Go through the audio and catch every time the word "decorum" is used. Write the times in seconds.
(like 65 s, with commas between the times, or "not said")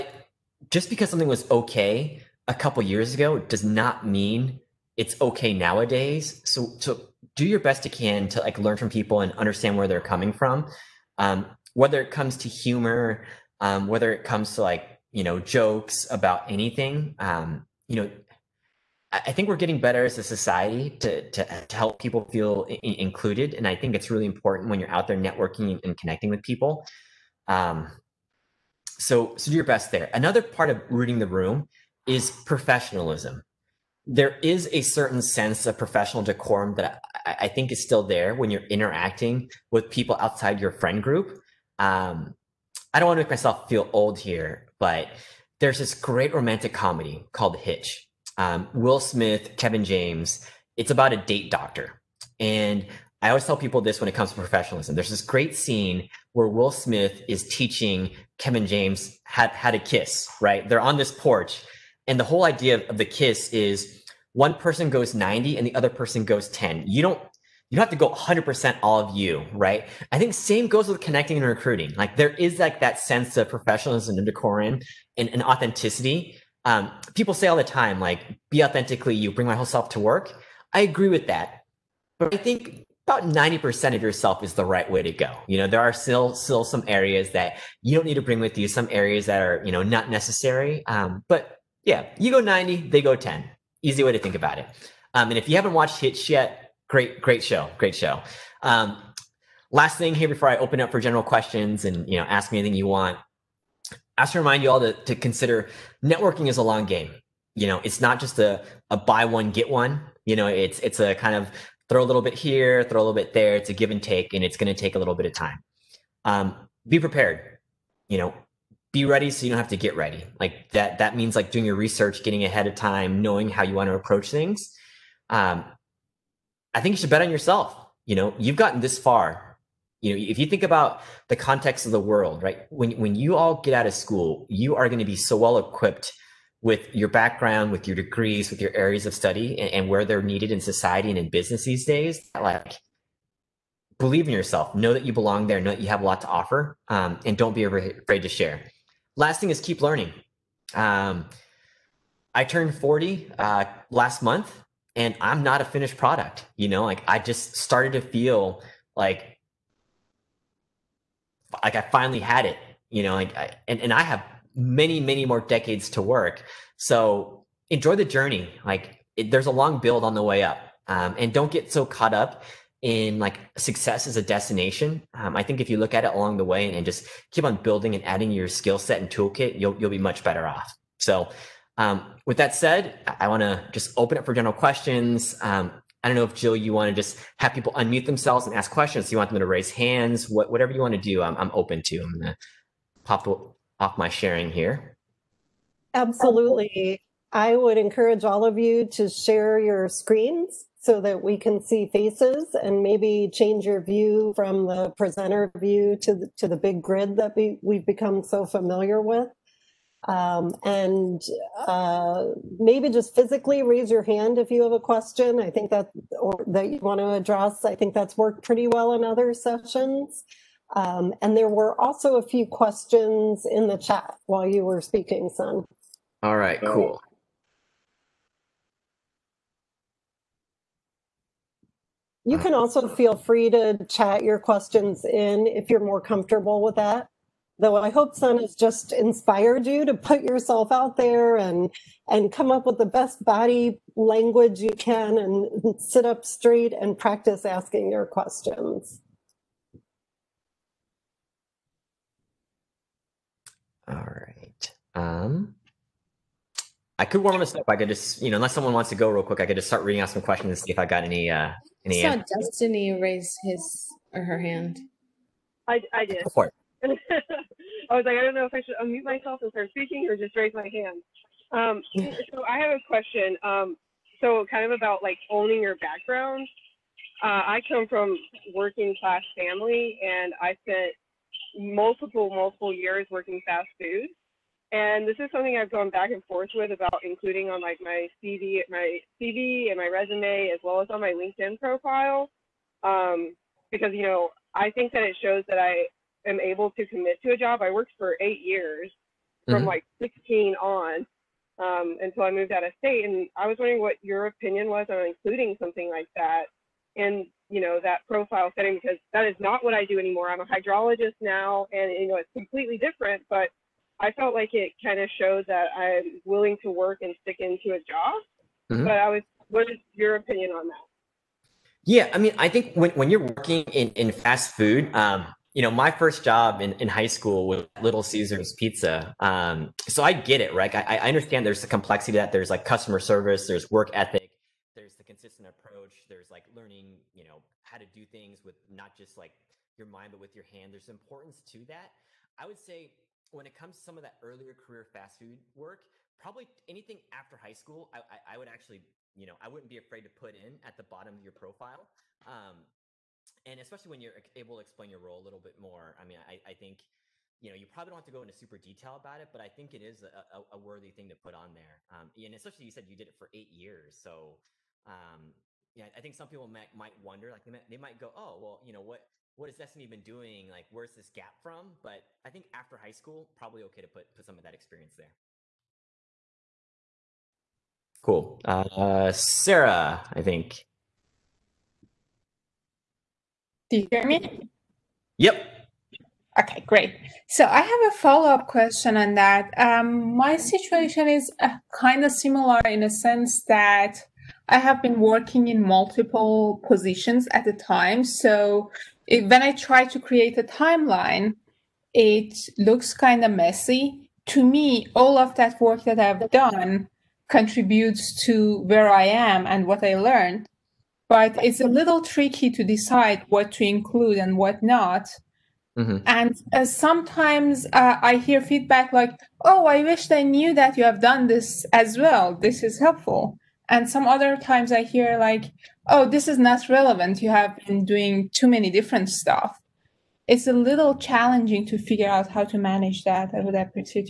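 36 s, 74 s.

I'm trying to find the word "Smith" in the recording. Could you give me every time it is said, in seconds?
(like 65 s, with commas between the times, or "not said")
48 s, 56 s.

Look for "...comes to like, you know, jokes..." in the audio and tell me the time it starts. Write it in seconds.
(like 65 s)
14 s.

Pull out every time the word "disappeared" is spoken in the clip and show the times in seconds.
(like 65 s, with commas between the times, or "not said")
not said.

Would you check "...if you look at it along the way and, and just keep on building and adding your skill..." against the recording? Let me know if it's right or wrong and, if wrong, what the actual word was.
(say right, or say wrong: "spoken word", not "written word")
right.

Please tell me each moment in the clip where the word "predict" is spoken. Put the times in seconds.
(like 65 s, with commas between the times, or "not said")
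not said.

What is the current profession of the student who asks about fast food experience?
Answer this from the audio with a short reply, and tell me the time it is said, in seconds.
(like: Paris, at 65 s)
Hydrologist, at 310 s.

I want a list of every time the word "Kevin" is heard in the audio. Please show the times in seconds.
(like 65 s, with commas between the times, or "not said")
49 s, 58 s.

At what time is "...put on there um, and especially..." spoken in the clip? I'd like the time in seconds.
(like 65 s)
361 s.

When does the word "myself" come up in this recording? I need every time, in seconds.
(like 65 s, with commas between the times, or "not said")
43 s, 269 s.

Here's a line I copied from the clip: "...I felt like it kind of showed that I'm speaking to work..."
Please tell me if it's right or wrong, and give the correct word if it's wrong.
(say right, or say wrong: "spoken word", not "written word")
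wrong: "willing", not "speaking".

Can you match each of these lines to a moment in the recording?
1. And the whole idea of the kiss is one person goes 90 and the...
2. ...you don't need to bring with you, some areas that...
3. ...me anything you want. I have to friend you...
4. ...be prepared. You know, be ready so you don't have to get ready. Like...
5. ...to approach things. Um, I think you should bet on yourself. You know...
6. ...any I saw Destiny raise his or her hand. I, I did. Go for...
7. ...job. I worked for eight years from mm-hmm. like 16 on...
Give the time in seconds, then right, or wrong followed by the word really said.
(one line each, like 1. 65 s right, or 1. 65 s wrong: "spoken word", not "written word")
1. 62 s right
2. 87 s right
3. 102 s wrong: "remind", not "friend"
4. 116 s right
5. 123 s right
6. 261 s right
7. 297 s right.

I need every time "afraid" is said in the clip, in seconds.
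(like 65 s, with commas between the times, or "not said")
147 s, 349 s.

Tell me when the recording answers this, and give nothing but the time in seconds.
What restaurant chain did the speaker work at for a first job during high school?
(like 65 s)
327 s.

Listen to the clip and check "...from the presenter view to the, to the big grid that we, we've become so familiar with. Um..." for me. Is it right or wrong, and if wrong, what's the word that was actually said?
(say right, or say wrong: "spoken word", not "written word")
right.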